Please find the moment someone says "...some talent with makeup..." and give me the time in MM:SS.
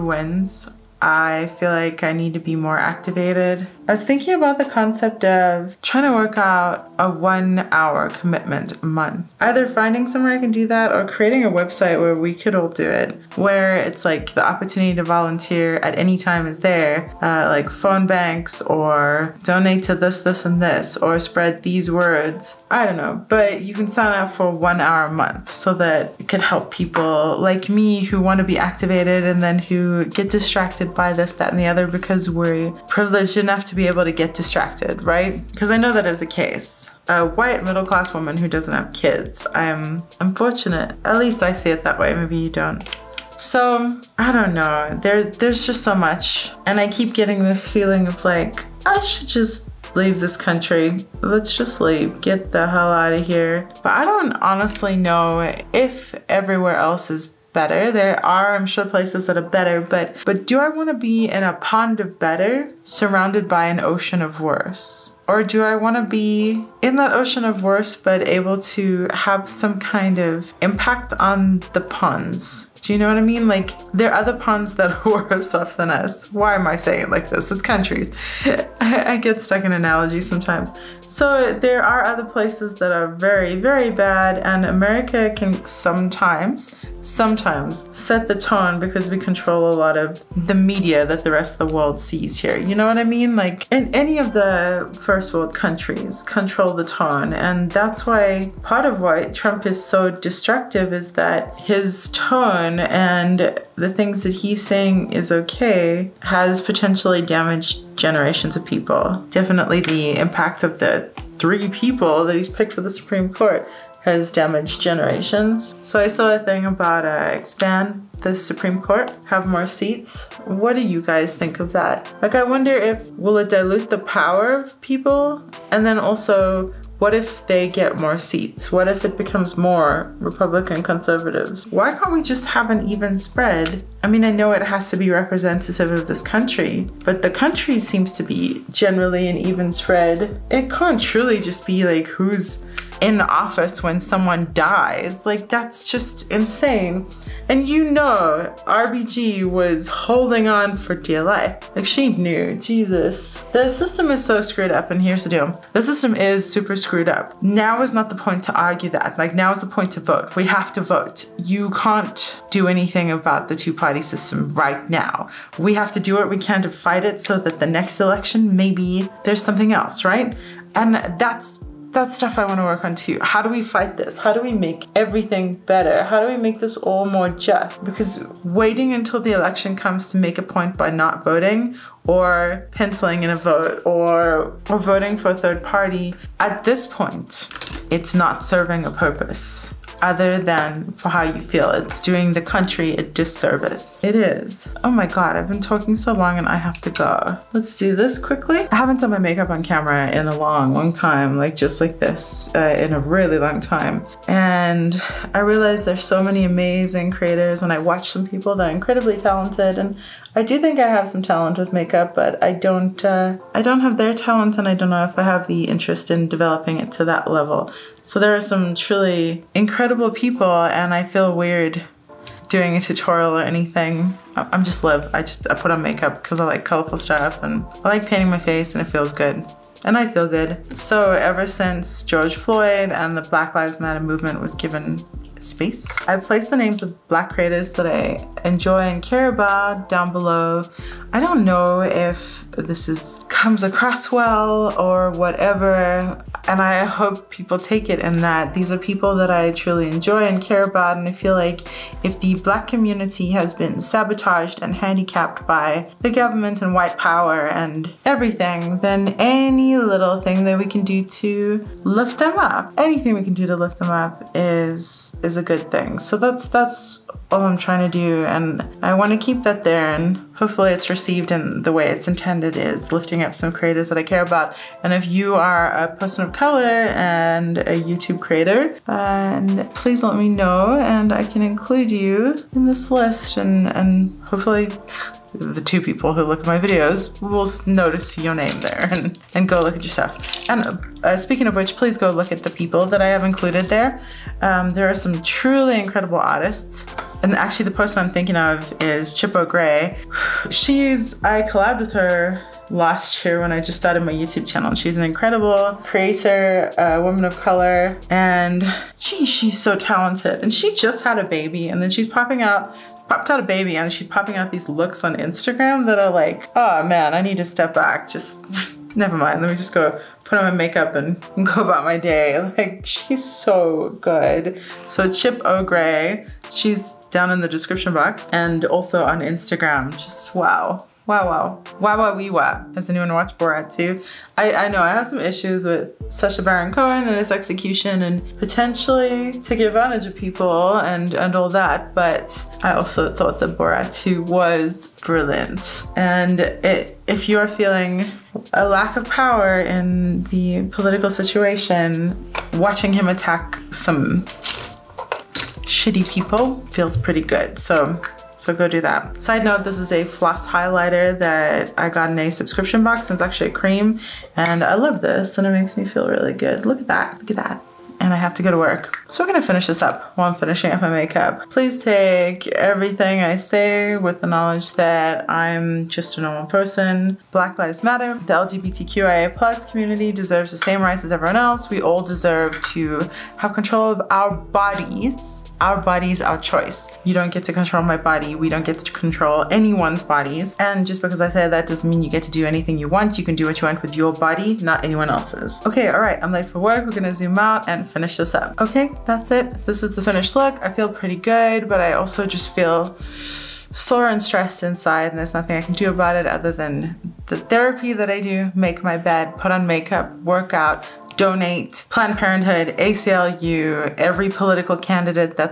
03:31.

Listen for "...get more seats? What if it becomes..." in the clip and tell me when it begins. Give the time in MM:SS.
02:07.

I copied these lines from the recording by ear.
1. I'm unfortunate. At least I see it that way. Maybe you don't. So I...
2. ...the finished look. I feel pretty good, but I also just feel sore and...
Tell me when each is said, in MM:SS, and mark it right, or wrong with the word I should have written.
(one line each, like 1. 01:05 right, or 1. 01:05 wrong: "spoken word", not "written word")
1. 00:39 right
2. 06:39 right.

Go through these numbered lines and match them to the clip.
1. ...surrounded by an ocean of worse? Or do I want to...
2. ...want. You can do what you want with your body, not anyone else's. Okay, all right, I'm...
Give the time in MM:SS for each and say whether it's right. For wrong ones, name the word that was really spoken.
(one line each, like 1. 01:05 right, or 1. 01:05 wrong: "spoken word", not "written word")
1. 01:02 right
2. 06:32 right.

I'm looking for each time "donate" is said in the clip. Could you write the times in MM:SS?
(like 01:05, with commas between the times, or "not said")
00:19, 06:51.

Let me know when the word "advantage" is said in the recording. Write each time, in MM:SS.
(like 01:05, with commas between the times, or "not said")
05:39.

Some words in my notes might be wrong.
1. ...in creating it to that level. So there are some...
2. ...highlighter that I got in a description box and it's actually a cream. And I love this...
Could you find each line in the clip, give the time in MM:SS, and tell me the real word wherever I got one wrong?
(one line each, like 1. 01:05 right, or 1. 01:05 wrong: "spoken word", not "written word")
1. 03:36 wrong: "developing", not "creating"
2. 06:00 wrong: "subscription", not "description".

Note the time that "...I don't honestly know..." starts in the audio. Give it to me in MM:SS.
00:53.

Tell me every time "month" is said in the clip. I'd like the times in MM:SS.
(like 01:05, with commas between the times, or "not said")
00:08, 00:25.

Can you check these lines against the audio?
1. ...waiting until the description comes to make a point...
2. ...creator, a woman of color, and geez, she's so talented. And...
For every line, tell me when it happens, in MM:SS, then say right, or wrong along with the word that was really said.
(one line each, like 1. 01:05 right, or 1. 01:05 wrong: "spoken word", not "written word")
1. 02:58 wrong: "election", not "description"
2. 05:05 right.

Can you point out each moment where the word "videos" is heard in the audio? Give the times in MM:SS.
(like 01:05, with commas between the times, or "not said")
04:46.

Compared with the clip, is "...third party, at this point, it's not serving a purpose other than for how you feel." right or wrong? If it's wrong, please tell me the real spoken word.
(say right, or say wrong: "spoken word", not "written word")
right.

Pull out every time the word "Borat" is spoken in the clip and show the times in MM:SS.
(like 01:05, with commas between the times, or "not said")
05:33, 05:43.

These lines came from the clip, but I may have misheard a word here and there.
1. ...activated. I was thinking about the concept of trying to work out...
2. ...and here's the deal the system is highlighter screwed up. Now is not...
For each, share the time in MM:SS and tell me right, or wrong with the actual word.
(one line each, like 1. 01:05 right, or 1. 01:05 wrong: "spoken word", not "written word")
1. 00:02 right
2. 02:34 wrong: "super", not "highlighter".